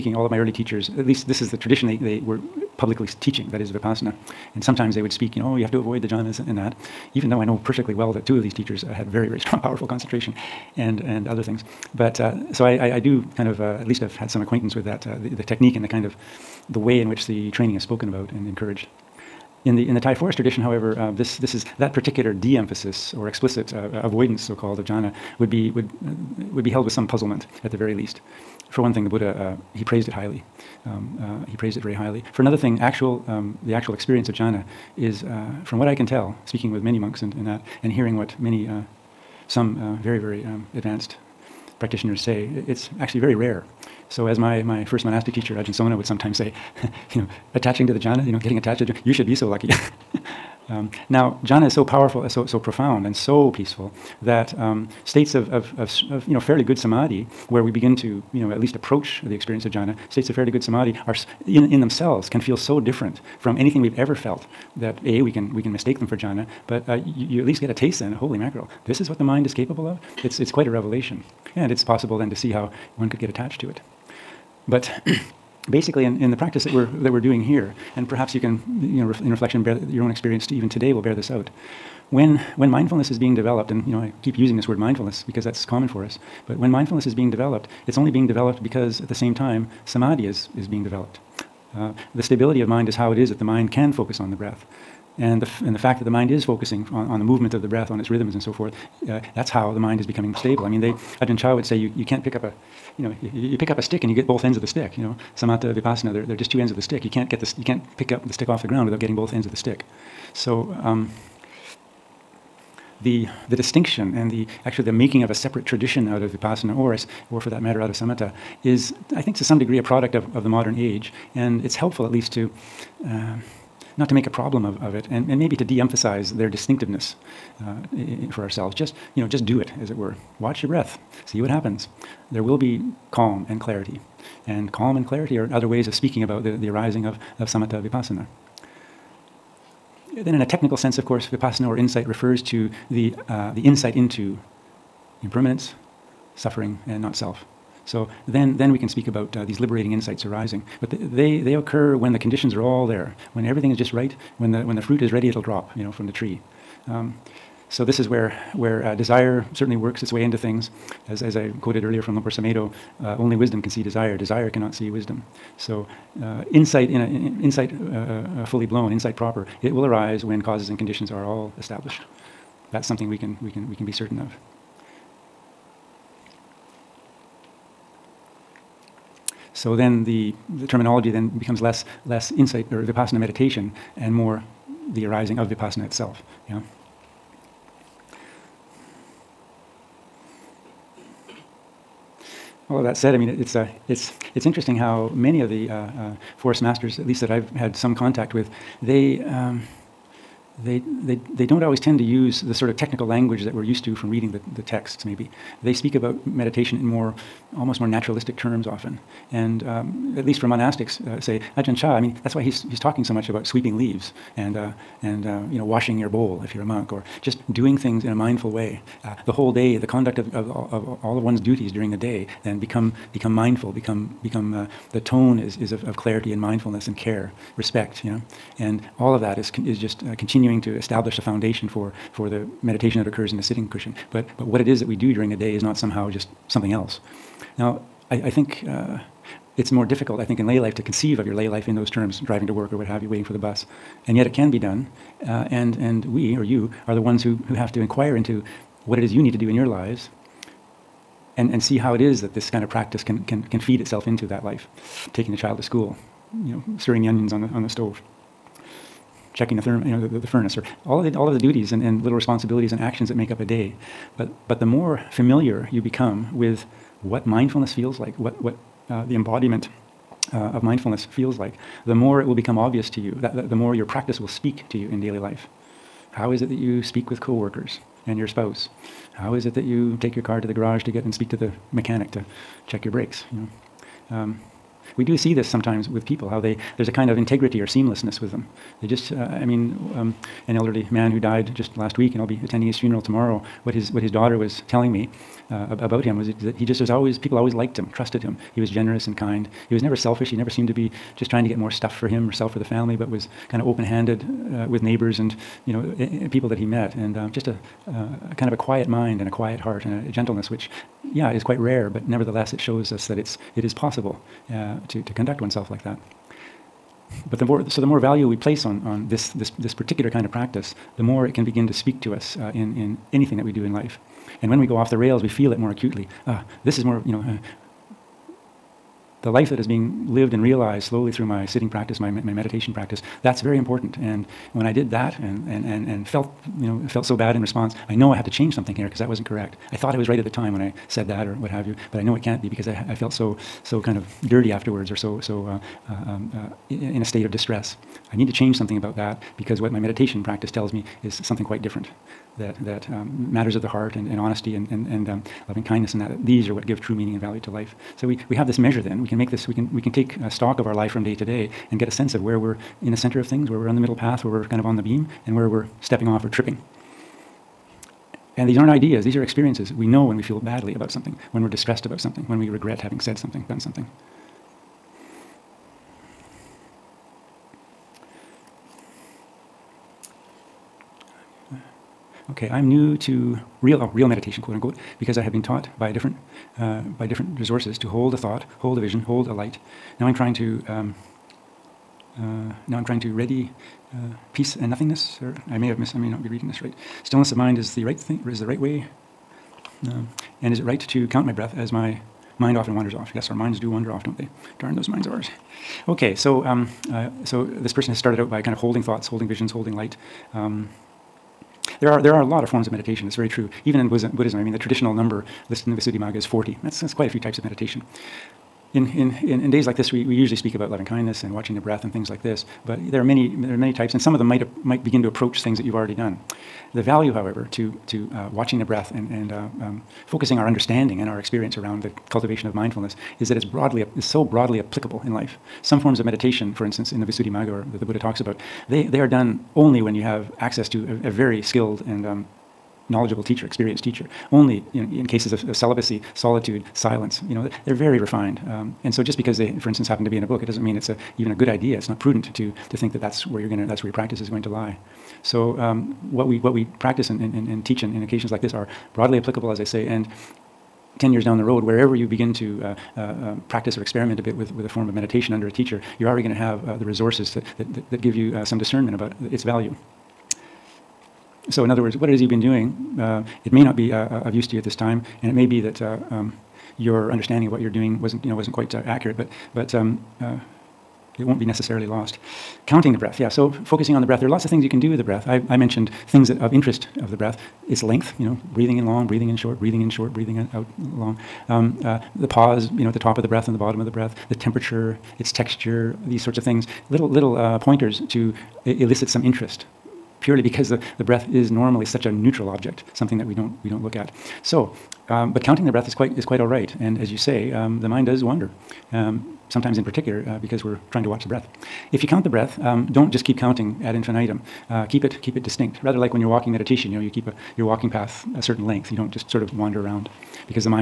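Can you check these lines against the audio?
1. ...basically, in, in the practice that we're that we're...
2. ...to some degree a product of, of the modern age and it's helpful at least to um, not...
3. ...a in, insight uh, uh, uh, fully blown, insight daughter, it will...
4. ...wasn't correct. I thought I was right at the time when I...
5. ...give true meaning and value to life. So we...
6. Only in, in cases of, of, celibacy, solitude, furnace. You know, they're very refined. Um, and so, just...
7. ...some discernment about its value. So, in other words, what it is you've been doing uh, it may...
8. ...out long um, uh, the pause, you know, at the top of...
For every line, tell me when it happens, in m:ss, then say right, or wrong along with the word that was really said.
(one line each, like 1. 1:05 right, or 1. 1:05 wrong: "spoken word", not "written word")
1. 1:15 right
2. 1:59 right
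3. 2:46 wrong: "proper", not "daughter"
4. 5:39 right
5. 5:56 right
6. 7:24 wrong: "silence", not "furnace"
7. 7:48 right
8. 8:10 right.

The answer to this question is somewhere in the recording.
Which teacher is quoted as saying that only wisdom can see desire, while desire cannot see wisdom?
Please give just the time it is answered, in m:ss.
2:42.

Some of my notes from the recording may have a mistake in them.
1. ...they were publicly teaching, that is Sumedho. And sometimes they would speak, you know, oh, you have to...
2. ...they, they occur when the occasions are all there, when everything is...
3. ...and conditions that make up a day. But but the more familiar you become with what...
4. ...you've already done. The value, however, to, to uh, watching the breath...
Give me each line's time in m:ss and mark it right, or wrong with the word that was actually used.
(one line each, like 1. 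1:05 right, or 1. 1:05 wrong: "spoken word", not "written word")
1. 0:01 wrong: "Vipassana", not "Sumedho"
2. 2:30 wrong: "conditions", not "occasions"
3. 4:22 wrong: "actions", not "conditions"
4. 7:05 right.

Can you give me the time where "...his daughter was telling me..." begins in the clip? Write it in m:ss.
4:54.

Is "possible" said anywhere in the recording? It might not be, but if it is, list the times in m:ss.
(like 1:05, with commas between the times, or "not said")
1:11, 5:13.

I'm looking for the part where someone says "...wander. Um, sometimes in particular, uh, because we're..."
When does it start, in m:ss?
8:28.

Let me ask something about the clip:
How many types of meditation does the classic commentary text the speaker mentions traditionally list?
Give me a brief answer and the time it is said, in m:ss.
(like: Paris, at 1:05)
40, at 6:56.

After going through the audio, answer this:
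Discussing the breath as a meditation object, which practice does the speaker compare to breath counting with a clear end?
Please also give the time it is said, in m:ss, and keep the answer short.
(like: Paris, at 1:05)
Walking meditation, at 8:36.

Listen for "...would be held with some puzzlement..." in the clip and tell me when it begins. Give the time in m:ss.
0:26.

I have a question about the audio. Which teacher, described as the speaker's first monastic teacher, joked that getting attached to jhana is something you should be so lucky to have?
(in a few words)
Ajahn Sona.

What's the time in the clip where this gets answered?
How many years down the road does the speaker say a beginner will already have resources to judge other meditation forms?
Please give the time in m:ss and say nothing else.
7:41.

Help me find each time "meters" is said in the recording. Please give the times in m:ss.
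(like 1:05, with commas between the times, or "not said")
not said.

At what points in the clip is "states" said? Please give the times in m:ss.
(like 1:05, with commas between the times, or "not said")
0:55, 1:00, 5:47.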